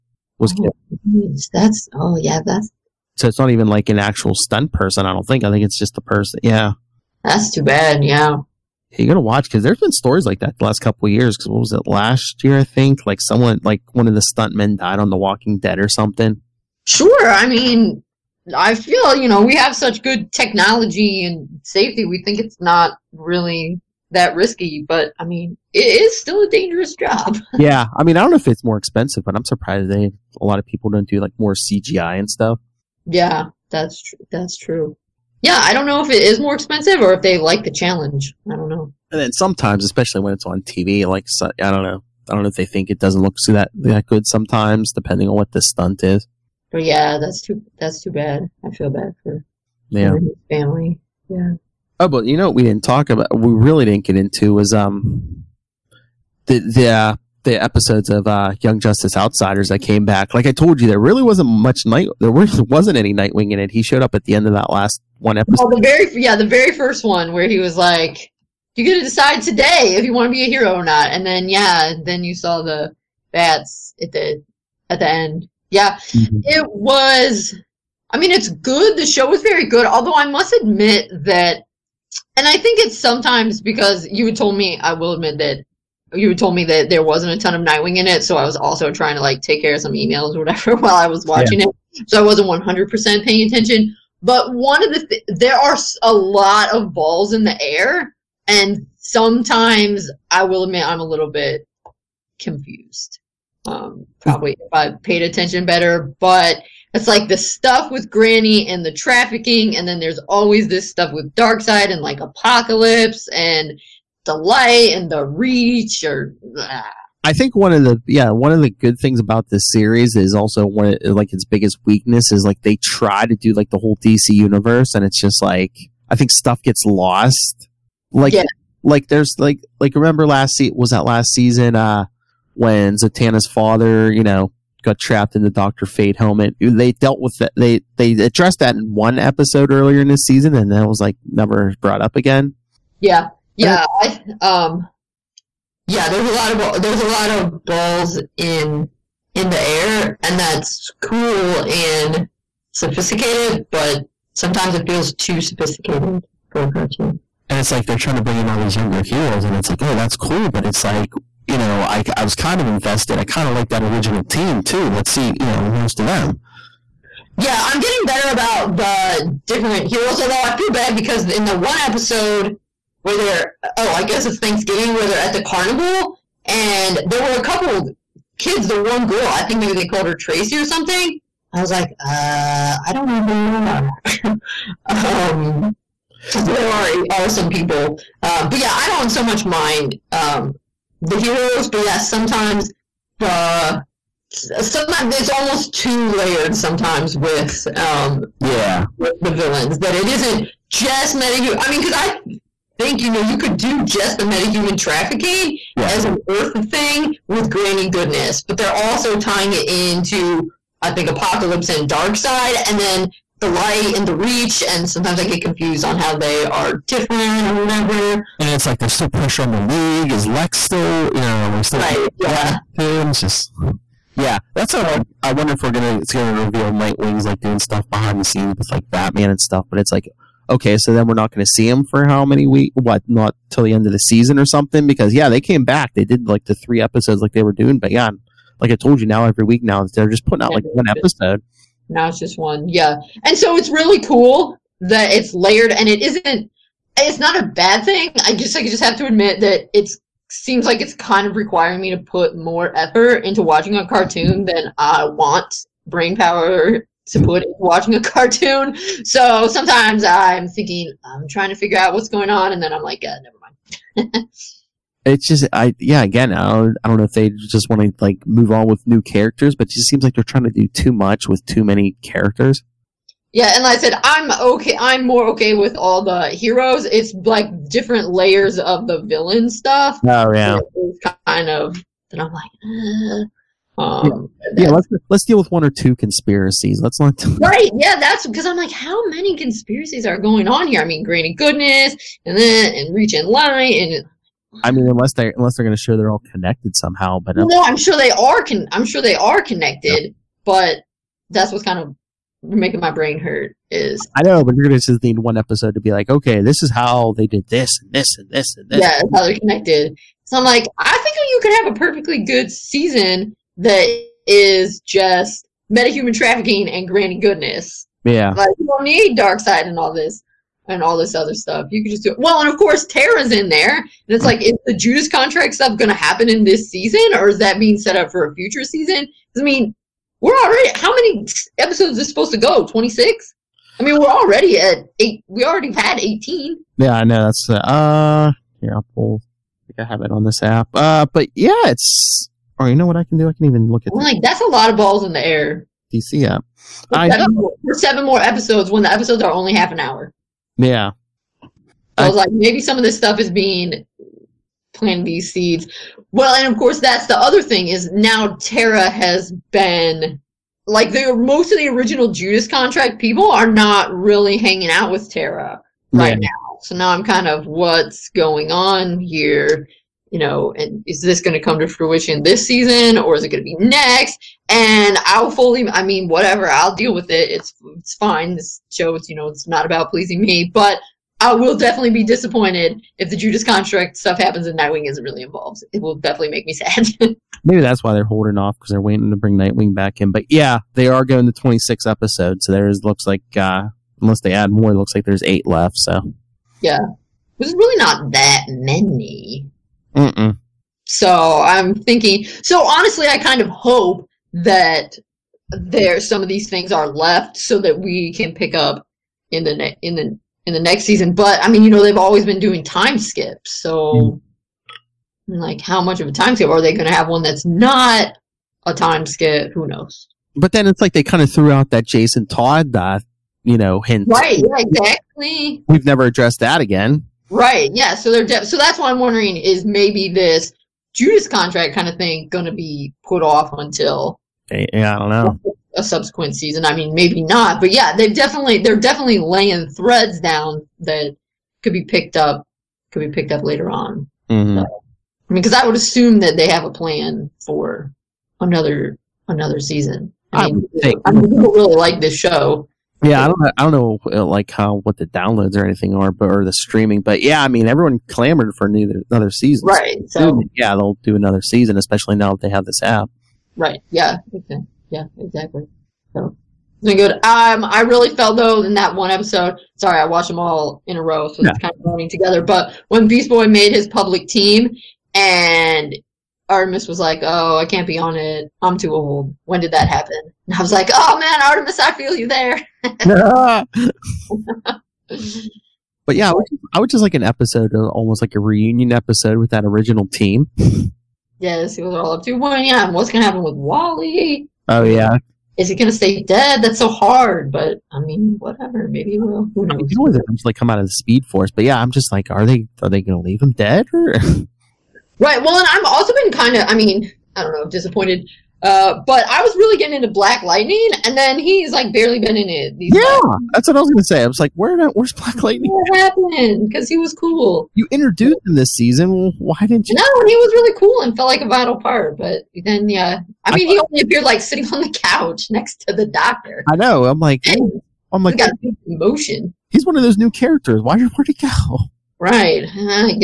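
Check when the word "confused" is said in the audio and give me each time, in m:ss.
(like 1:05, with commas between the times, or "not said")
1:42, 3:35.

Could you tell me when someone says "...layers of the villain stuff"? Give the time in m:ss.
4:38.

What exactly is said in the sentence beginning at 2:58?
The one girl I think maybe they called her Tracy or something.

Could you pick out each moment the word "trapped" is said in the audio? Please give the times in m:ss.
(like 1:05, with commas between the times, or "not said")
2:14.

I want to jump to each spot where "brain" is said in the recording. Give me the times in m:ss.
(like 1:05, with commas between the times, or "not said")
4:15, 5:02.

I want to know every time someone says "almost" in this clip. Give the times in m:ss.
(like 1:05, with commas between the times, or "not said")
3:15, 8:07.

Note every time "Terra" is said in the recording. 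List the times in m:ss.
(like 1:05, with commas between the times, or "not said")
5:22, 5:58, 6:05.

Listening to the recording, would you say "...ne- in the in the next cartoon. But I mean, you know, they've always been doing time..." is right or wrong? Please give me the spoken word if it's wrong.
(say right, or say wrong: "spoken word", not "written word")
wrong: "season", not "cartoon".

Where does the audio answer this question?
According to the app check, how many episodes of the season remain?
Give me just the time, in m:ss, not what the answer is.
6:35.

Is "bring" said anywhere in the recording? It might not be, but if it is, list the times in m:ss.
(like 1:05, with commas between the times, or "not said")
2:38, 6:29.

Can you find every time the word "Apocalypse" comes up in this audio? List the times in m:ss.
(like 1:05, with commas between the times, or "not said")
1:52, 3:31.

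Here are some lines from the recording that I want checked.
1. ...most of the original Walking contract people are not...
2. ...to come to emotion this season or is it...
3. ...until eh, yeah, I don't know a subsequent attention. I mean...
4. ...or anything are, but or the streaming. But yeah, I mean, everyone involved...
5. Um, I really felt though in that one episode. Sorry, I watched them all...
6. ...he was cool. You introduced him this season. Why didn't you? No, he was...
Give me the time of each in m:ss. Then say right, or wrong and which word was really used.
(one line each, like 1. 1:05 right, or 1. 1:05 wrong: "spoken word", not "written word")
1. 6:01 wrong: "Judas", not "Walking"
2. 6:11 wrong: "fruition", not "emotion"
3. 7:13 wrong: "season", not "attention"
4. 7:35 wrong: "clamored", not "involved"
5. 7:47 right
6. 8:36 right.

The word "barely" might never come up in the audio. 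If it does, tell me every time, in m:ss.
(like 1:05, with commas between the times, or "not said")
8:31.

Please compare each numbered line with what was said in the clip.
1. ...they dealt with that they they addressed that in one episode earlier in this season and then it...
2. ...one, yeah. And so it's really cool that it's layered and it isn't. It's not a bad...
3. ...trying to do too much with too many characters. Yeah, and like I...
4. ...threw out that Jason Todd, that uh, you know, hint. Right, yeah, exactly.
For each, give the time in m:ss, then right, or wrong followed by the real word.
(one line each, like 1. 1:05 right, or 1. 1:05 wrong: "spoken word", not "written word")
1. 2:16 right
2. 4:02 right
3. 4:30 right
4. 7:01 right.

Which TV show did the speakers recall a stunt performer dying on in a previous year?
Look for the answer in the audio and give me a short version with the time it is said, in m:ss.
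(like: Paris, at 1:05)
The Walking Dead, at 0:15.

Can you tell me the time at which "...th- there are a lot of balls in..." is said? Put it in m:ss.
1:35.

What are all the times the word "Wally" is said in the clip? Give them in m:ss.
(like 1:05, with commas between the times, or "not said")
8:13.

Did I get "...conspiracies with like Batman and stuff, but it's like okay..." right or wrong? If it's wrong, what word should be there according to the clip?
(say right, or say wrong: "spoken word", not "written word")
wrong: "scenes", not "conspiracies".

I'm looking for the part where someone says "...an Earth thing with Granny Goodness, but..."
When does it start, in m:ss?
3:26.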